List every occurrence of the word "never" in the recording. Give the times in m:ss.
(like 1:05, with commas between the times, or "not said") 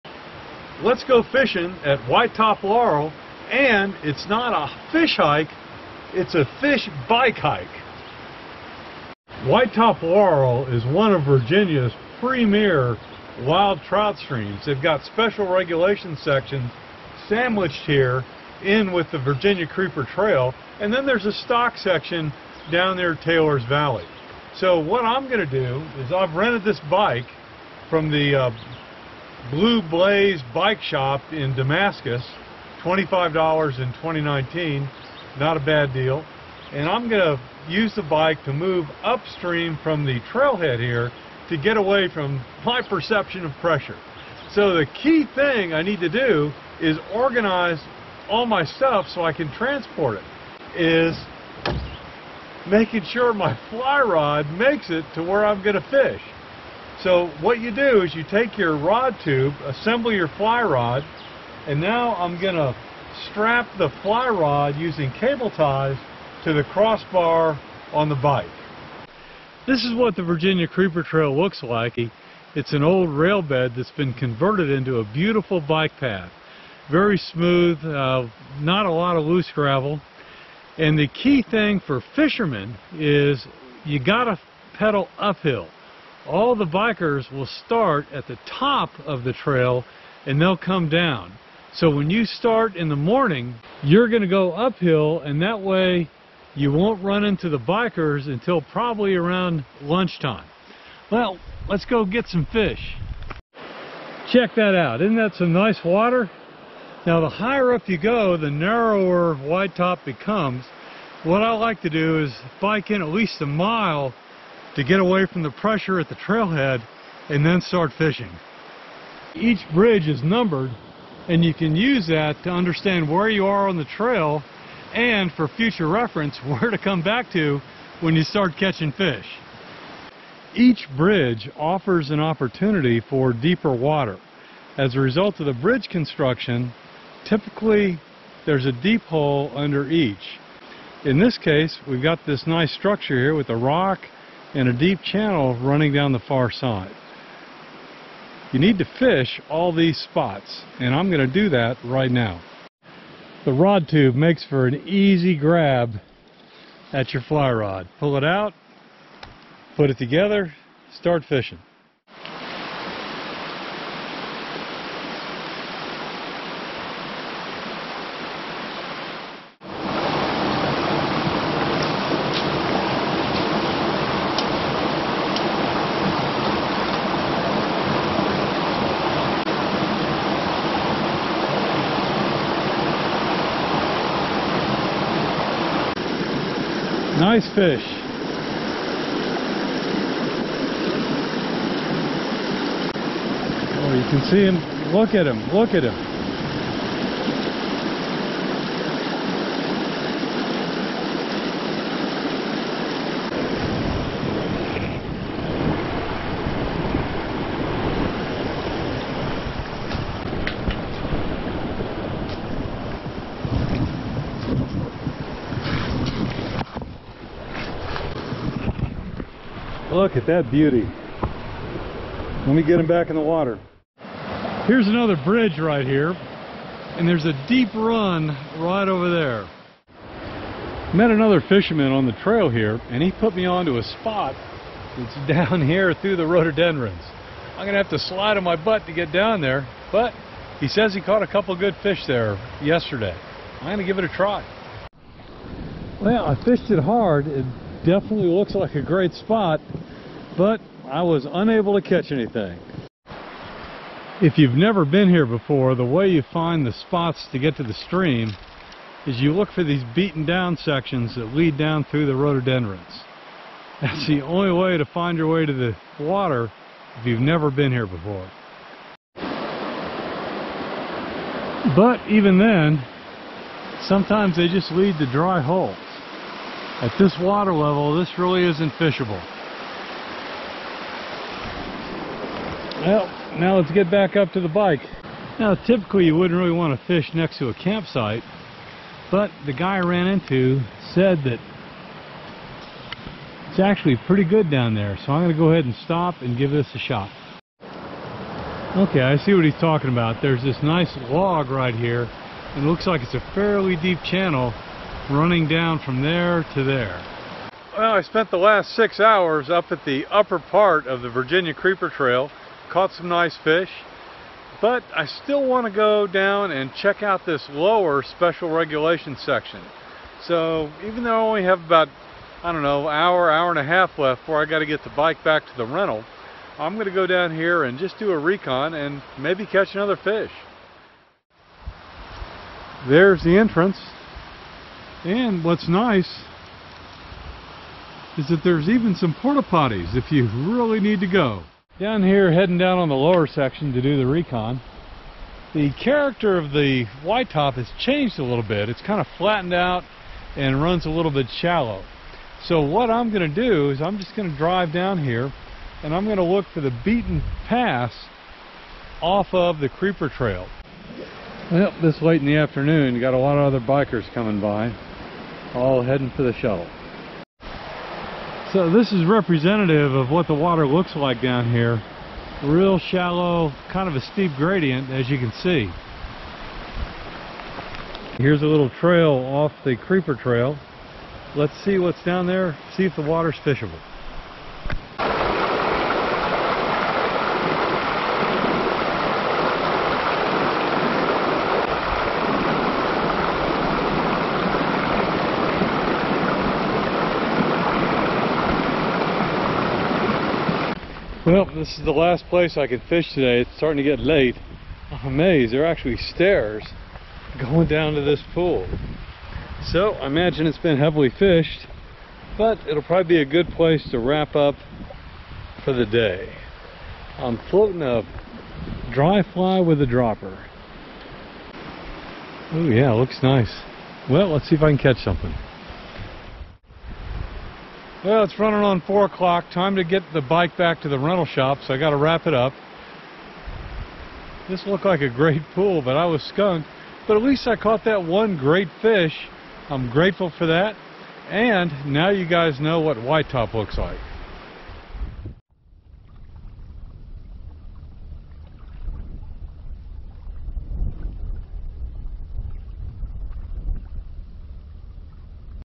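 4:14, 4:27.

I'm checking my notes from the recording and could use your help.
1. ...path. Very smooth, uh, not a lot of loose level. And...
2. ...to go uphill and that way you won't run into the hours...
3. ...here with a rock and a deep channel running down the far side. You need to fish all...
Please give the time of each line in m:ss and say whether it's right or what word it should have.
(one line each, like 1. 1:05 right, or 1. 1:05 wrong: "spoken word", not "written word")
1. 1:15 wrong: "gravel", not "level"
2. 1:34 wrong: "bikers", not "hours"
3. 2:23 right.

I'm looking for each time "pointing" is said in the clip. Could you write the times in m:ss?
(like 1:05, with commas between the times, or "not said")
not said.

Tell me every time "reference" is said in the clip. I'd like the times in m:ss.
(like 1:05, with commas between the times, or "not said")
2:05.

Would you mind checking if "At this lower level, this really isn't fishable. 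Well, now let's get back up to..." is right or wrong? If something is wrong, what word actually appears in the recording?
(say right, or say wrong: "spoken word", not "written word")
wrong: "water", not "lower".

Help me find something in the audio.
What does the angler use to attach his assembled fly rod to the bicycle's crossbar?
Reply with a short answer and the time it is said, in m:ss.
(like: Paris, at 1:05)
Cable ties, at 1:05.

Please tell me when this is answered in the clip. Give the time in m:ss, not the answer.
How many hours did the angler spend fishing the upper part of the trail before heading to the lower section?
5:08.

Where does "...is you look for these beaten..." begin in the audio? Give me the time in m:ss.
4:19.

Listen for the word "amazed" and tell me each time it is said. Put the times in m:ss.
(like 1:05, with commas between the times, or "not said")
6:45.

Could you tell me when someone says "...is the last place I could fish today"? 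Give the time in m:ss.
6:41.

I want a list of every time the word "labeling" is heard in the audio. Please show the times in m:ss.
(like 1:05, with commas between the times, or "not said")
not said.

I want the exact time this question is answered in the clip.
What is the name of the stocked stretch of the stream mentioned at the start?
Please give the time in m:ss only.
0:23.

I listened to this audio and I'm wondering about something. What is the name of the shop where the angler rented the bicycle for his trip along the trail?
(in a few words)
Blue Blaze Bike Shop.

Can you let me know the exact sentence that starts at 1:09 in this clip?
This is what the Virginia Creeper Trail looks like.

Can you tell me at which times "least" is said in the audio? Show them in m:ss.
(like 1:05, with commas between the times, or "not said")
1:53, 7:17.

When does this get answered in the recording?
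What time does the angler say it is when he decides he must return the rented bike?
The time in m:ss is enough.
7:08.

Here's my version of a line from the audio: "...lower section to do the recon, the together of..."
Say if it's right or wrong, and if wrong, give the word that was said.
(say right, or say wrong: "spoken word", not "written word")
wrong: "character", not "together".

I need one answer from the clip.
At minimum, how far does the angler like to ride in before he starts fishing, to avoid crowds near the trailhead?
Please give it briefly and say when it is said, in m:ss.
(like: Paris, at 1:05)
1 mile, at 1:53.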